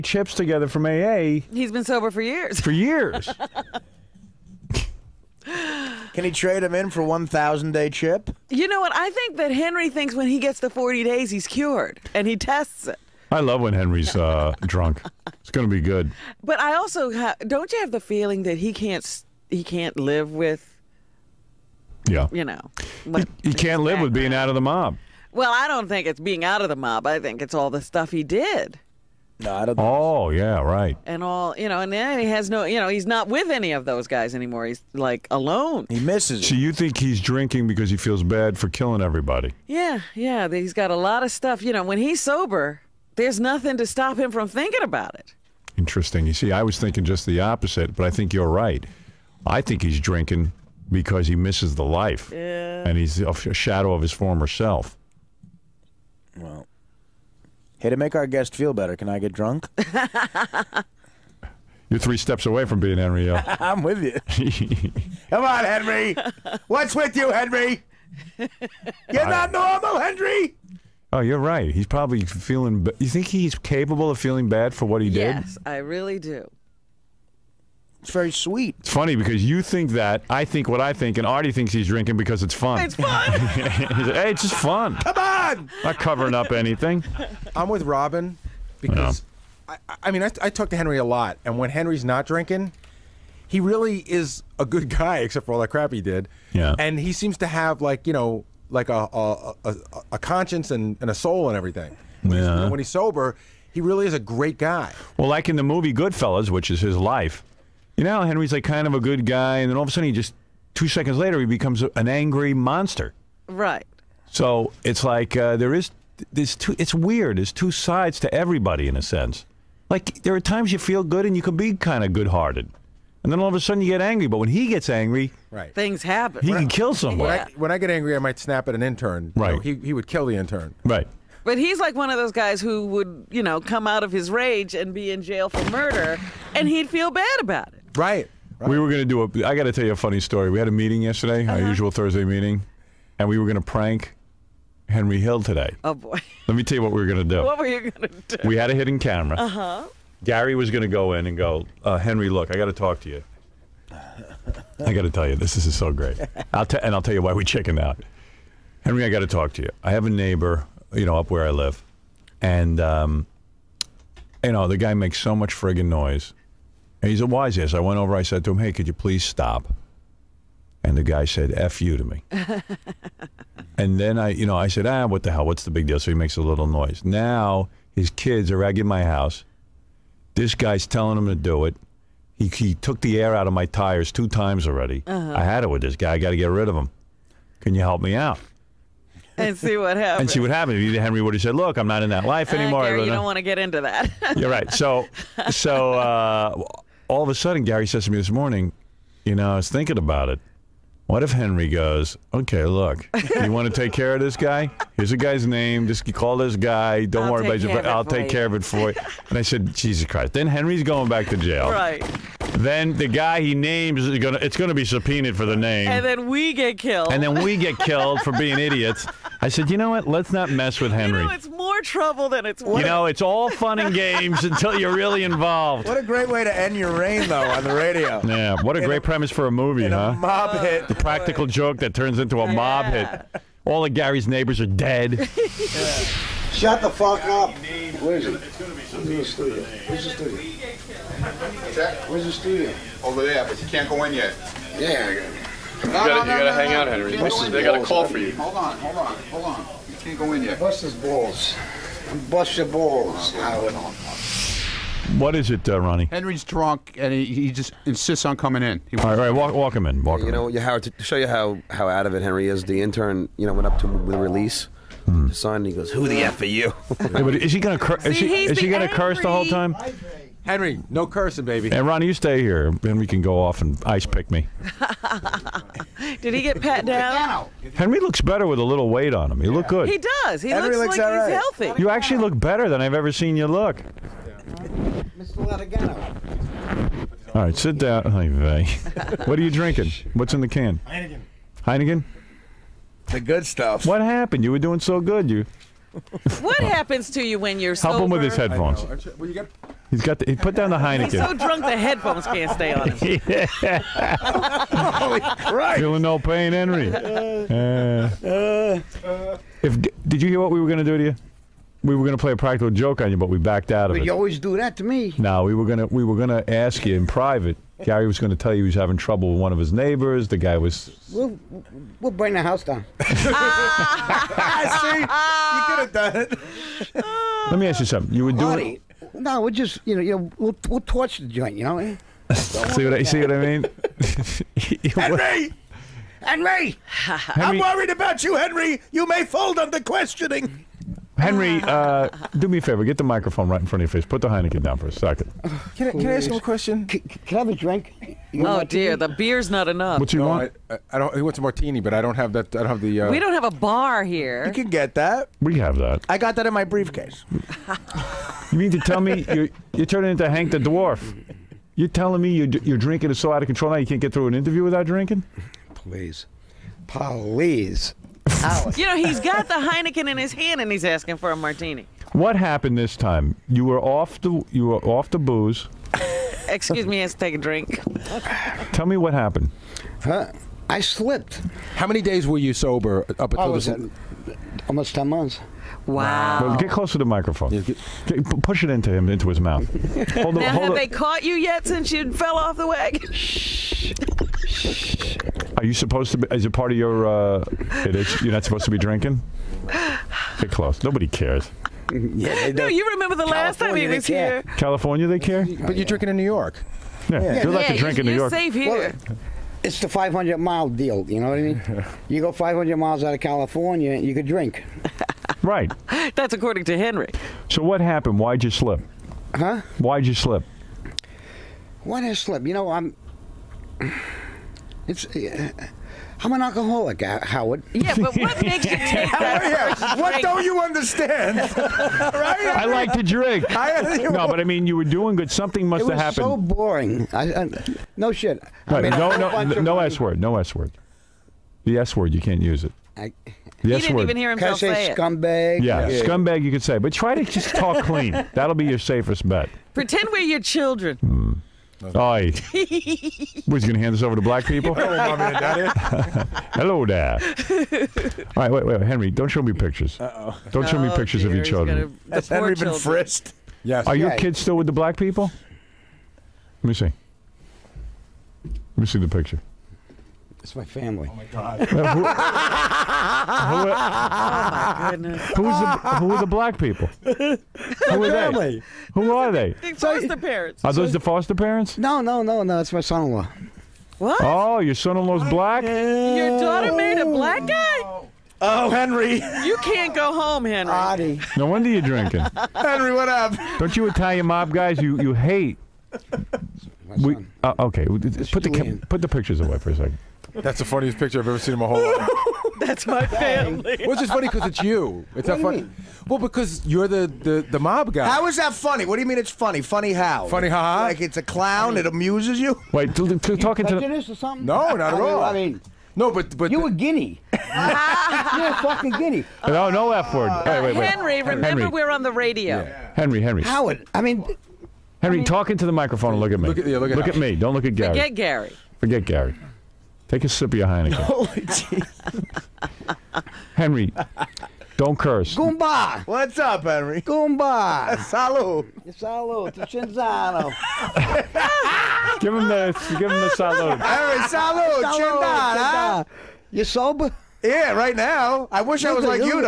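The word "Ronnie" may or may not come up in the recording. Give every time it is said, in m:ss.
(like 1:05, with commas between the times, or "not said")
4:15, 4:31.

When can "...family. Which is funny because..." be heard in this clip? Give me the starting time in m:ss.
8:23.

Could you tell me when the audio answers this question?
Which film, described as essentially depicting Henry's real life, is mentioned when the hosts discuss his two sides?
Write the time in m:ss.
1:45.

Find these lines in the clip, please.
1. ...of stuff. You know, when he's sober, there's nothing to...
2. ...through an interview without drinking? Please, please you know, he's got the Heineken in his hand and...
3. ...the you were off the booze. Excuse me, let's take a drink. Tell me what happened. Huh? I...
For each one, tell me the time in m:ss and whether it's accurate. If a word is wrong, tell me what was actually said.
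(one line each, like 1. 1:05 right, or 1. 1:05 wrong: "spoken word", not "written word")
1. 0:41 right
2. 6:04 right
3. 6:14 right.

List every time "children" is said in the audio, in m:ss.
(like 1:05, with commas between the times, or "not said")
7:30, 7:41.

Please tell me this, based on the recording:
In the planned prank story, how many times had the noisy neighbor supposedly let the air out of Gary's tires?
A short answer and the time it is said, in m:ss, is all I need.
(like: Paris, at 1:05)
2, at 3:04.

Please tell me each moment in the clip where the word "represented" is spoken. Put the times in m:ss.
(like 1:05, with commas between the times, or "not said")
not said.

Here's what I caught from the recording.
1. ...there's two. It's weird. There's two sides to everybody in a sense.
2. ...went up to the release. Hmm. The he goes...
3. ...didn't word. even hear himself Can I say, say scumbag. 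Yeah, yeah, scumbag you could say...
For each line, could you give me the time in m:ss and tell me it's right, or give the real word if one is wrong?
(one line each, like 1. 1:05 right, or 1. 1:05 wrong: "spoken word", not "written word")
1. 1:56 right
2. 4:23 right
3. 7:23 right.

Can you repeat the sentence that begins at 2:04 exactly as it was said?
But when he gets angry, right, things happen.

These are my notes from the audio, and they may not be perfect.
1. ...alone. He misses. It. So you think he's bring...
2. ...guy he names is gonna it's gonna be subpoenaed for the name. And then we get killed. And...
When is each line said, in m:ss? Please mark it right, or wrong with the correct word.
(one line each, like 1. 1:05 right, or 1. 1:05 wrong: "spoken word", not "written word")
1. 0:35 wrong: "drinking", not "bring"
2. 3:33 right.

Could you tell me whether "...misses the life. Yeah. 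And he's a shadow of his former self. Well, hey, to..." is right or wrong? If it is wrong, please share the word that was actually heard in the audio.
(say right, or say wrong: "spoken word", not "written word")
right.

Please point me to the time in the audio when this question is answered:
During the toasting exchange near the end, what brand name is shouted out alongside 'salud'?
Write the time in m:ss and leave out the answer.
8:59.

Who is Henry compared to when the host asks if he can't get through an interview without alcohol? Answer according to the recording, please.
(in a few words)
Hank the Dwarf.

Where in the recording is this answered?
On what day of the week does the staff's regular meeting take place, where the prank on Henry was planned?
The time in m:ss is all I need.
2:21.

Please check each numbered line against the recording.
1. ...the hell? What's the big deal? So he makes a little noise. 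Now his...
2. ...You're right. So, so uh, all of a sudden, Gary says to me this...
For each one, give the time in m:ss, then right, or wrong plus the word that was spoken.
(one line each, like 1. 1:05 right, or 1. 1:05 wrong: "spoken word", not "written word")
1. 2:55 right
2. 3:14 right.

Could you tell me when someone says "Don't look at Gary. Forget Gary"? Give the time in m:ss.
8:47.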